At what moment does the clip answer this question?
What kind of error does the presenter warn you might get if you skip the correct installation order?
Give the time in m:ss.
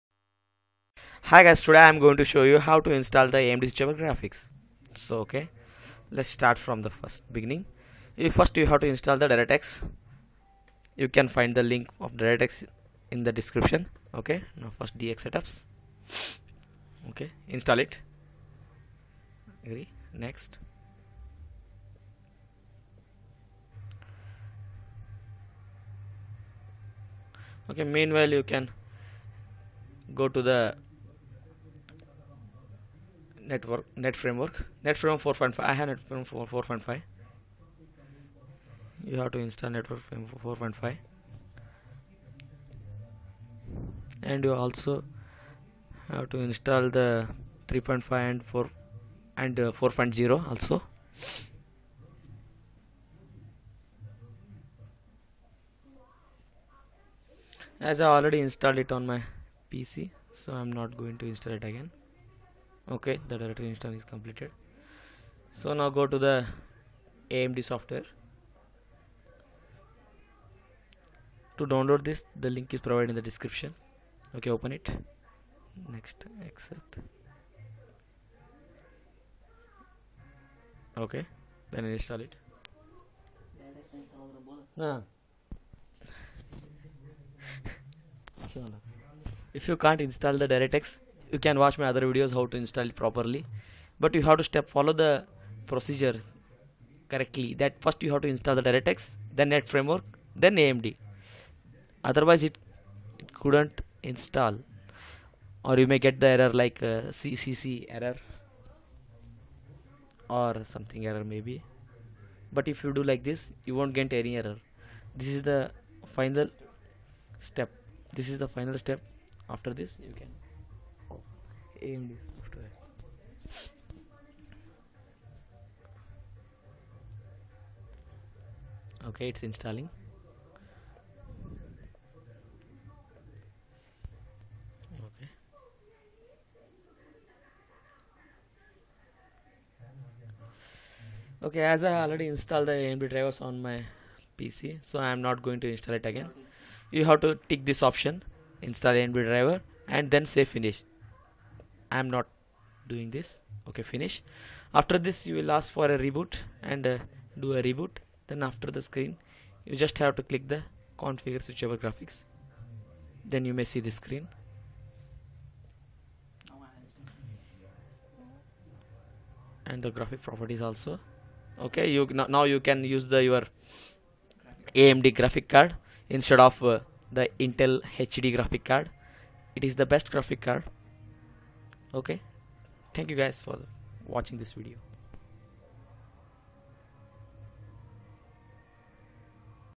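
1:47.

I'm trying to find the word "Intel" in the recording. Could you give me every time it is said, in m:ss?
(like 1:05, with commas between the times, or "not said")
2:57.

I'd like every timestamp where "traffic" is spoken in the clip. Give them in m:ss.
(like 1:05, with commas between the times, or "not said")
not said.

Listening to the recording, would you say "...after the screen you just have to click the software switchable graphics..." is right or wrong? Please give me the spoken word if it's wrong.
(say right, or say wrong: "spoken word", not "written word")
wrong: "configure", not "software".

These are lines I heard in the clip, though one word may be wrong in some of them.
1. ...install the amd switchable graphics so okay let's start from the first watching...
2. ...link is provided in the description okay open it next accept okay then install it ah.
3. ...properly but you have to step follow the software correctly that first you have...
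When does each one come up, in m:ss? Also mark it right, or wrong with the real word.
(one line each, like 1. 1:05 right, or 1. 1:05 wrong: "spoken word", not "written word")
1. 0:02 wrong: "beginning", not "watching"
2. 1:12 right
3. 1:33 wrong: "procedure", not "software".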